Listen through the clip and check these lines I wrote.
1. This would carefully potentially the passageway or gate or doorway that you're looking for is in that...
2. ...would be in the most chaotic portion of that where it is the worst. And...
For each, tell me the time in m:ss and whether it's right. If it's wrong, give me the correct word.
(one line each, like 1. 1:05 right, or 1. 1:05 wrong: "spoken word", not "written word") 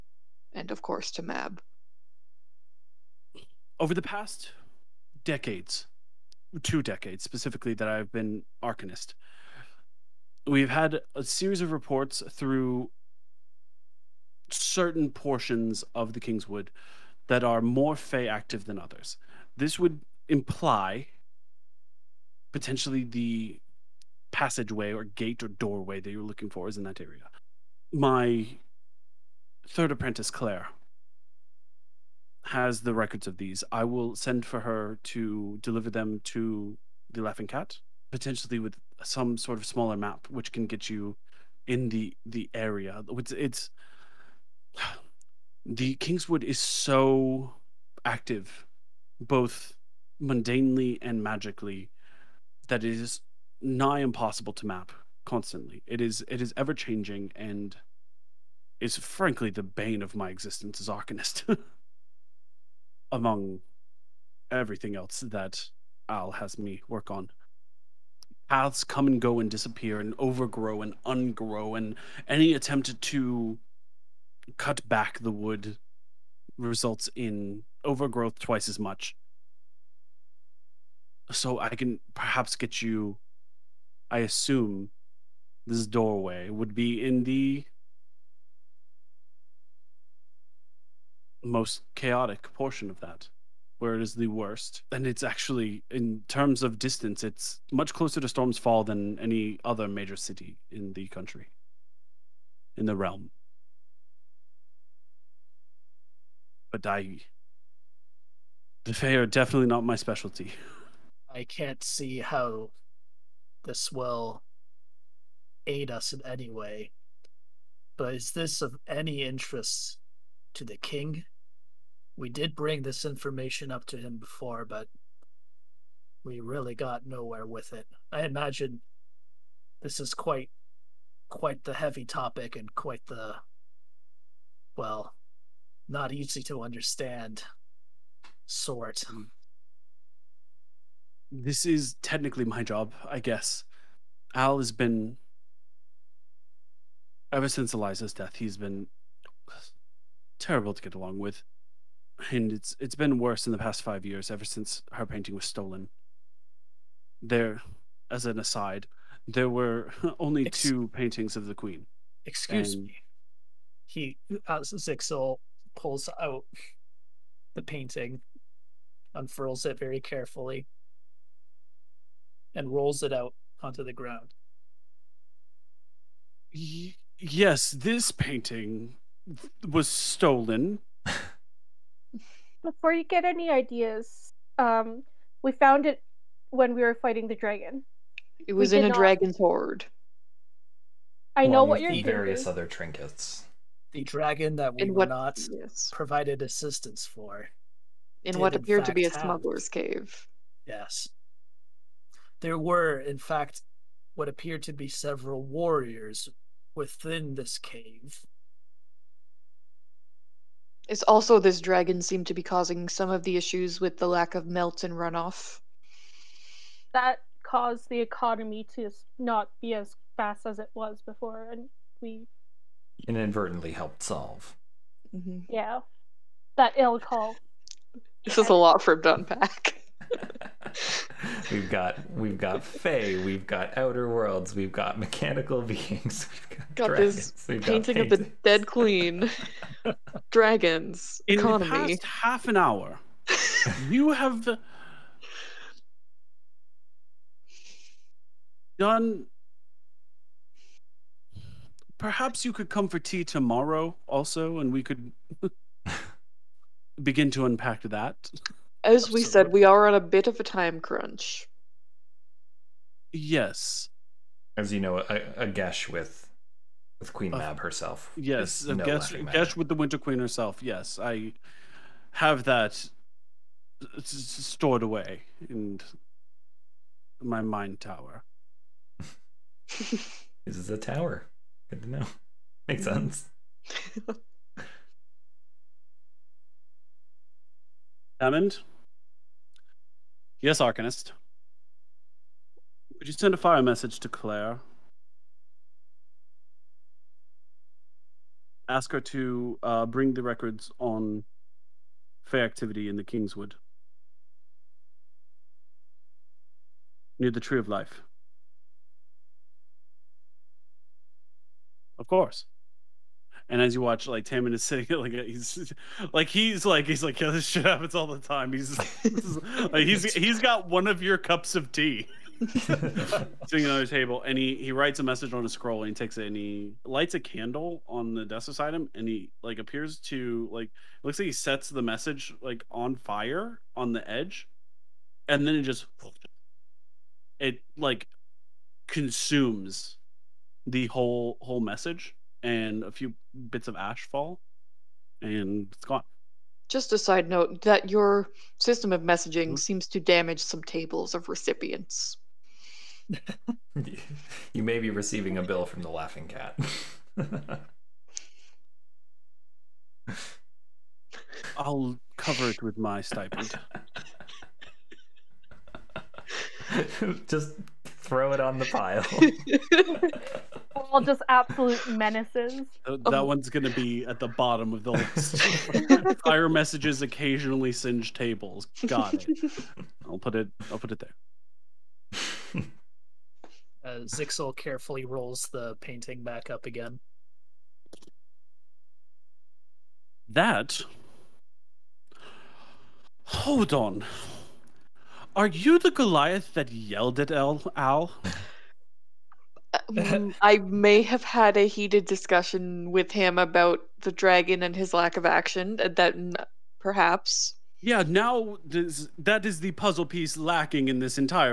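1. 0:19 wrong: "imply", not "carefully"
2. 1:26 right.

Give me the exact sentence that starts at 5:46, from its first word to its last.
Just a side note that your system of messaging mm-hmm.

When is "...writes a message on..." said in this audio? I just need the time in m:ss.
5:24.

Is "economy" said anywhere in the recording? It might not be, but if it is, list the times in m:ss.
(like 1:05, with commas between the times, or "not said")
3:38, 4:01.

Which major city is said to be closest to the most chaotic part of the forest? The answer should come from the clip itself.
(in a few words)
Storm's Fall.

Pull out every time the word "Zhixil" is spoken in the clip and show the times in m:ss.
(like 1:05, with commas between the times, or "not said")
2:44, 6:24.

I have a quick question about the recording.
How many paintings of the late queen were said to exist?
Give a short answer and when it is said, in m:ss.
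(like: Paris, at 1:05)
2, at 2:40.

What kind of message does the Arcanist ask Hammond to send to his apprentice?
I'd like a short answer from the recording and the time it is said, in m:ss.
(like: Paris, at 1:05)
A fire message, at 4:53.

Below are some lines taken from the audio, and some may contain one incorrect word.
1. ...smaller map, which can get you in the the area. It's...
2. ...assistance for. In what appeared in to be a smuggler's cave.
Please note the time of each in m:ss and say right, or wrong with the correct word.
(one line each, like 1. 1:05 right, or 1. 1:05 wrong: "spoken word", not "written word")
1. 0:39 right
2. 3:16 right.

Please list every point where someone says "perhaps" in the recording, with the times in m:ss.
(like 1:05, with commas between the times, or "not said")
1:22, 4:11, 6:46.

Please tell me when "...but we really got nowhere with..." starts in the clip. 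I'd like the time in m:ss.
2:04.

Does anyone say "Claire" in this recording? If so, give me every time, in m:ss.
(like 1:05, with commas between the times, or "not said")
0:30, 4:54.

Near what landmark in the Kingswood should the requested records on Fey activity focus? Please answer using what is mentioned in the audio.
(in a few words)
The Tree of Life.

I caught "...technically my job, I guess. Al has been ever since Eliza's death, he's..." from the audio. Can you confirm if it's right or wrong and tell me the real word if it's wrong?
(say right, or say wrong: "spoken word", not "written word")
right.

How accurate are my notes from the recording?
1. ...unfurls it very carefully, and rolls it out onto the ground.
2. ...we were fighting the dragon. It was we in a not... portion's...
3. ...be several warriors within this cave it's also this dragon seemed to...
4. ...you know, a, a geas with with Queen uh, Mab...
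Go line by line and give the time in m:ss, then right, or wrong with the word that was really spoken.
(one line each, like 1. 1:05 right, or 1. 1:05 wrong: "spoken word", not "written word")
1. 2:49 right
2. 3:06 wrong: "dragon", not "portion"
3. 3:24 right
4. 4:24 right.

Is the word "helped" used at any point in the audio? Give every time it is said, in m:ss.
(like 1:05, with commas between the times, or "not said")
3:43.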